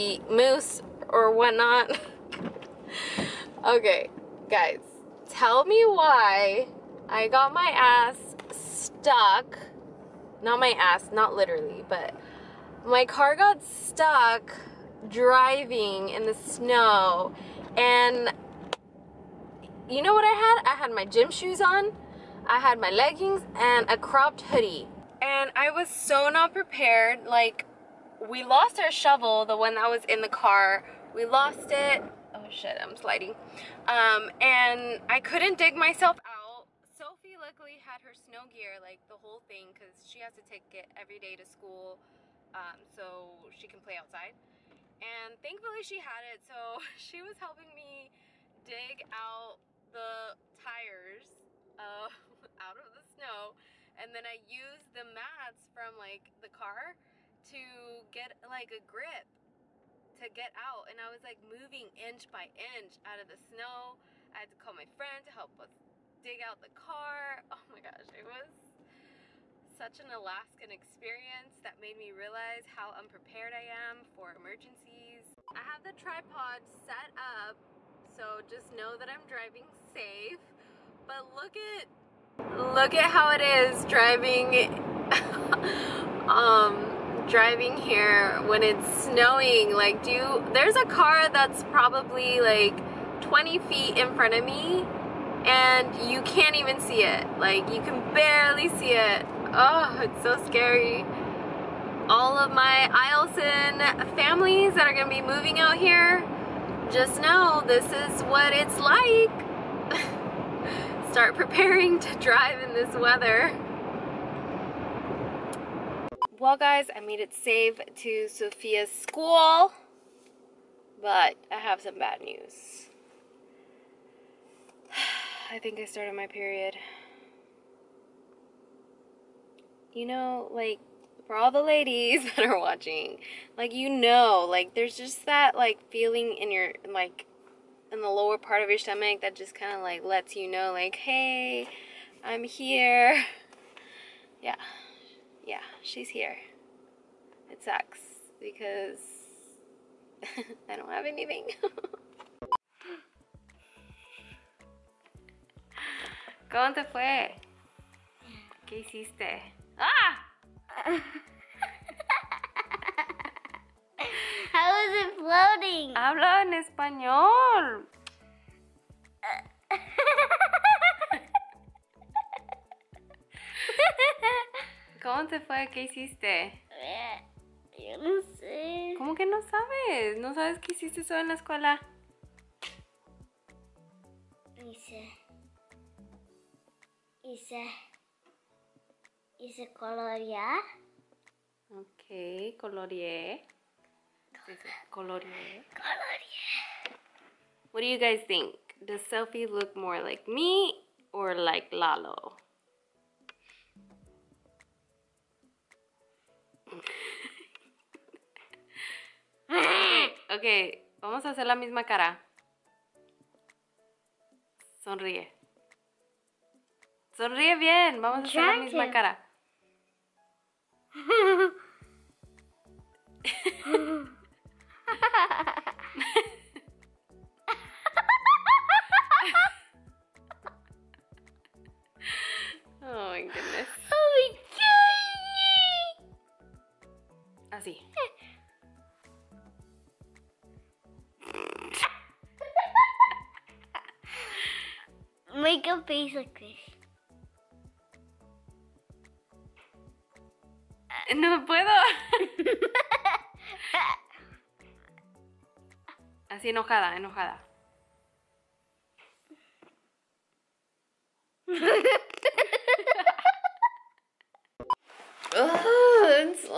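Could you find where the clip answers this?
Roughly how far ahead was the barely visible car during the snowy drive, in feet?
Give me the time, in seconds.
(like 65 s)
93 s.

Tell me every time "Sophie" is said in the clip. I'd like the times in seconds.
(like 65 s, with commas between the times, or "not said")
36 s, 199 s.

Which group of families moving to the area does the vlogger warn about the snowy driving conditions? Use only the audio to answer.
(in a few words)
Eielson families.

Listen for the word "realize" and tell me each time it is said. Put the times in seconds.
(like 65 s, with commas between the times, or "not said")
72 s.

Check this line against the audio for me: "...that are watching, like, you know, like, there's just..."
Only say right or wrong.
right.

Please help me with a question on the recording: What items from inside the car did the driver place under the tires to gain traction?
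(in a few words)
The mats.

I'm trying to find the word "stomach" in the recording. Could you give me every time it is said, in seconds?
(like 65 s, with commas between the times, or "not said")
138 s.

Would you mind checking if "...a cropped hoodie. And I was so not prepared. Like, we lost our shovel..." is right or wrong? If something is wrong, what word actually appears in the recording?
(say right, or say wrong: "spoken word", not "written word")
right.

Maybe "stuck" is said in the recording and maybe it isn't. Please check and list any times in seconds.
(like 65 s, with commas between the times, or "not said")
8 s, 13 s.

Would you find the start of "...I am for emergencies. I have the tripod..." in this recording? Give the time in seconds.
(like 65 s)
73 s.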